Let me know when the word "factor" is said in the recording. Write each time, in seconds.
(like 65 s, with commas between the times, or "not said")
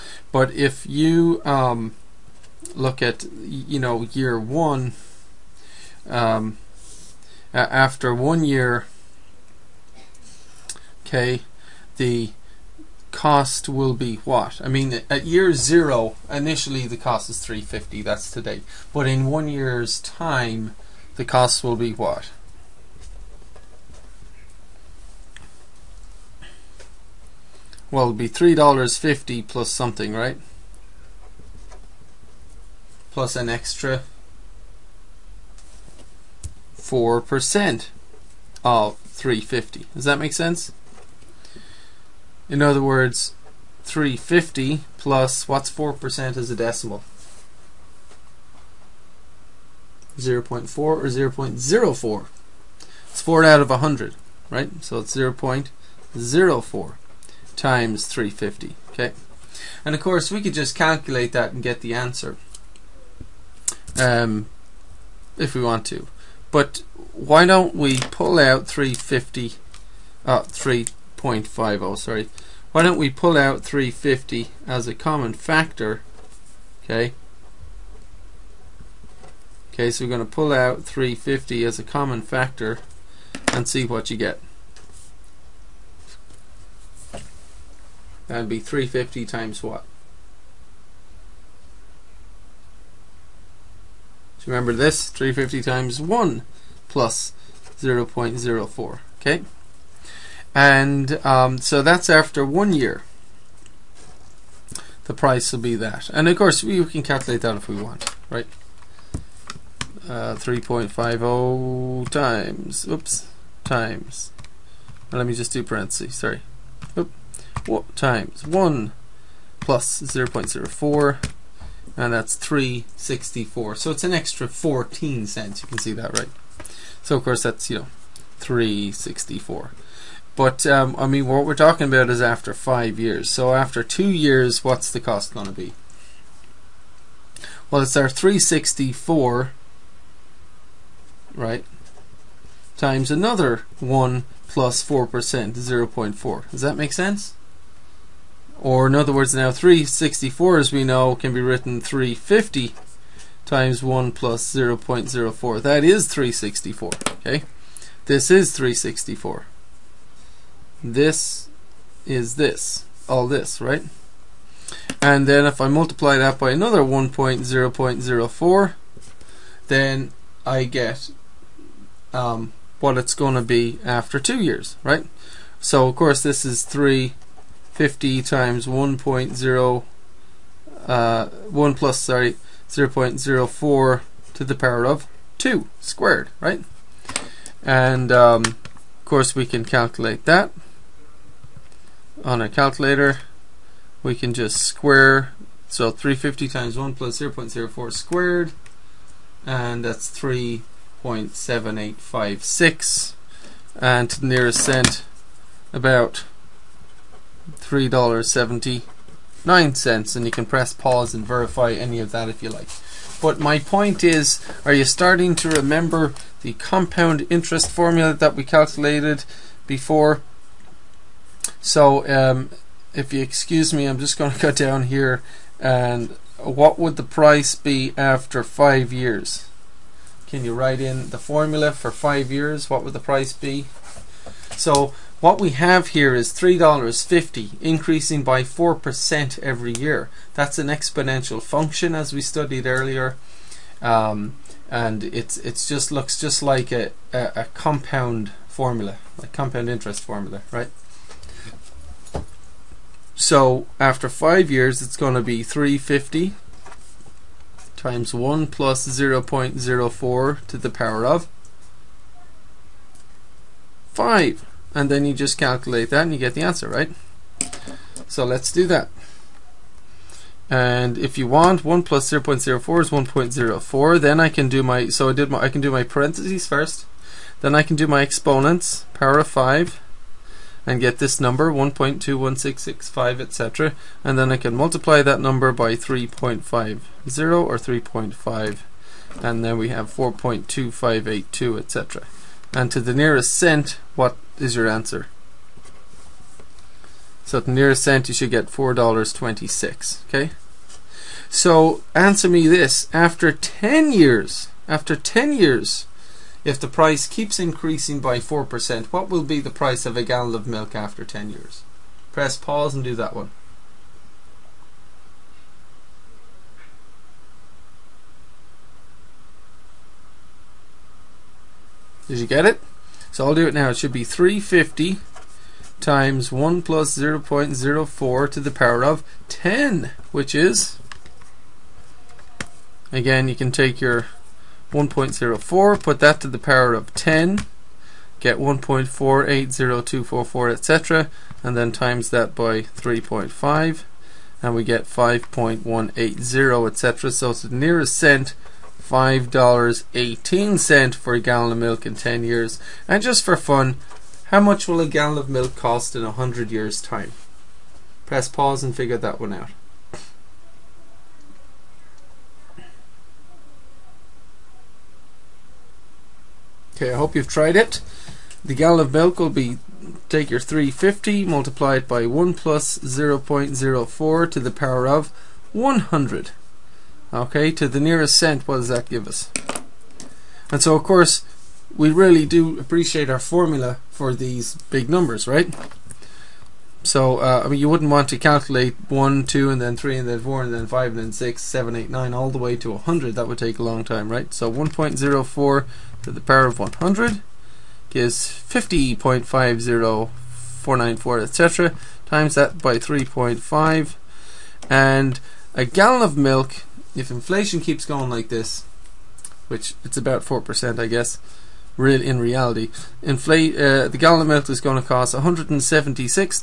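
75 s, 82 s.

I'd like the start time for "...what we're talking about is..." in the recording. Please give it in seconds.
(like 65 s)
131 s.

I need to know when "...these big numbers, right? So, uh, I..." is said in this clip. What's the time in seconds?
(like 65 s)
384 s.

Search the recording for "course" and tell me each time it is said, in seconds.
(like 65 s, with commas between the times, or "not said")
60 s, 106 s, 127 s, 175 s, 189 s, 380 s.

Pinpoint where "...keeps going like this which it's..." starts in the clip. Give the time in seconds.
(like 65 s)
407 s.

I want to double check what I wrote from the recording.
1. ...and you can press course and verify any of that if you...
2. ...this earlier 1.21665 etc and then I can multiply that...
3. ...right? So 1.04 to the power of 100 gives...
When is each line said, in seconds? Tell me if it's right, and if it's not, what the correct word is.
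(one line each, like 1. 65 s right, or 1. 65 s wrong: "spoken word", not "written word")
1. 210 s wrong: "pause", not "course"
2. 280 s wrong: "number", not "earlier"
3. 394 s right.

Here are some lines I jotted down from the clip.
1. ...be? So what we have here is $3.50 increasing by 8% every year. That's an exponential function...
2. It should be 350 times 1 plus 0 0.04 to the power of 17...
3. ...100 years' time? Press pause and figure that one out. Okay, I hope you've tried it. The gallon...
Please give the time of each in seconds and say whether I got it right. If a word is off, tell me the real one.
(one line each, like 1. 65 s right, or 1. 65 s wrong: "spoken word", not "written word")
1. 233 s wrong: "4", not "8"
2. 323 s wrong: "10", not "17"
3. 356 s right.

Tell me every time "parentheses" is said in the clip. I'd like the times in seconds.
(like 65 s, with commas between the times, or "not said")
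115 s, 275 s.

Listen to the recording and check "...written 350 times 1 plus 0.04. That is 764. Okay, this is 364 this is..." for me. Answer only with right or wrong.
wrong.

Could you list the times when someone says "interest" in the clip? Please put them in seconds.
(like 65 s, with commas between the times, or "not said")
217 s, 249 s.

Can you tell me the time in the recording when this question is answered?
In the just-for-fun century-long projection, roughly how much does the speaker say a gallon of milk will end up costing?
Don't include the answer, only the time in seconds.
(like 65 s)
415 s.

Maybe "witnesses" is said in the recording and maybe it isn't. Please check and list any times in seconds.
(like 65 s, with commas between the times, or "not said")
not said.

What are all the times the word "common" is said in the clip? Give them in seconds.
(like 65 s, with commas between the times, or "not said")
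74 s, 81 s.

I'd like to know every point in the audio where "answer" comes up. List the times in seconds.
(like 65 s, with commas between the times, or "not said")
61 s, 266 s, 294 s, 301 s.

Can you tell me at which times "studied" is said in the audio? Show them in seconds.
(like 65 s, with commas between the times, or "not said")
242 s.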